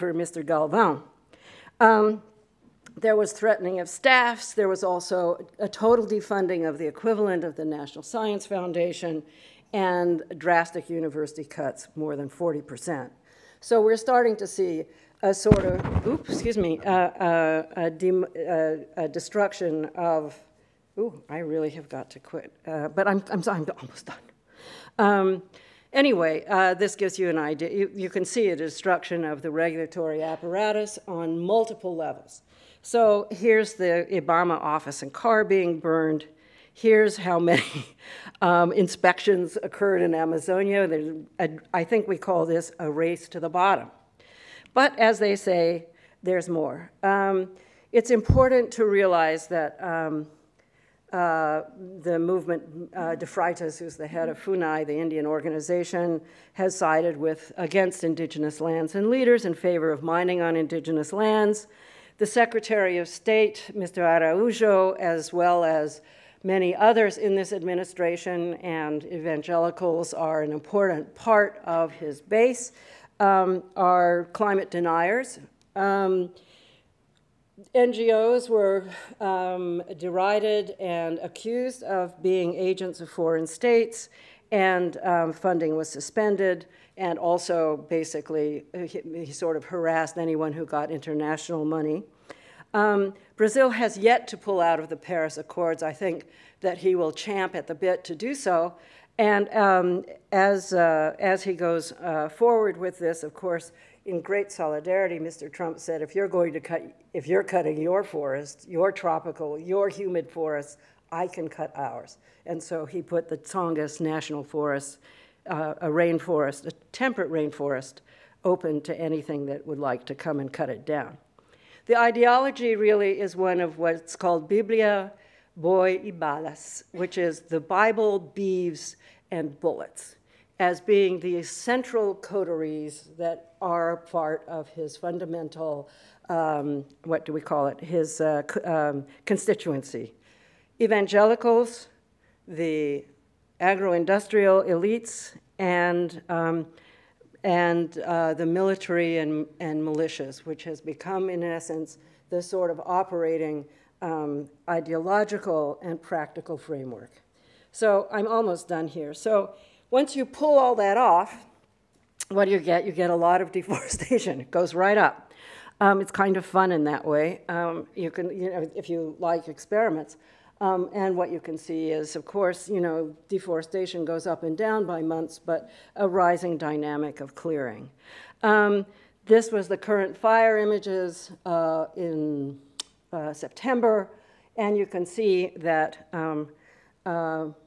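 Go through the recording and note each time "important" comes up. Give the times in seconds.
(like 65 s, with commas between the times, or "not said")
48 s, 70 s.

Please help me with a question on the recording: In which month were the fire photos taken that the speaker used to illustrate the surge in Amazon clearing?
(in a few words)
September.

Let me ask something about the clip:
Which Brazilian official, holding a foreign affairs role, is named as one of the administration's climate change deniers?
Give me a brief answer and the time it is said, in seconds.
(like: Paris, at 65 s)
Araujo, at 63 s.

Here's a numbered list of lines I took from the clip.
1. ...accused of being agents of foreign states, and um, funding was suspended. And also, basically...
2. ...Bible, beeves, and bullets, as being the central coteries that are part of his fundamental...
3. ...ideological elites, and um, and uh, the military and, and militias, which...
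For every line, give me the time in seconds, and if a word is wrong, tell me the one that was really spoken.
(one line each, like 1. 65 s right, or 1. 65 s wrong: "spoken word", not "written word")
1. 81 s right
2. 127 s right
3. 143 s wrong: "industrial", not "ideological".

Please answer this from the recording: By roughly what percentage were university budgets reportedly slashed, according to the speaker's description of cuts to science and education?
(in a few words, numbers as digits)
more than 40%.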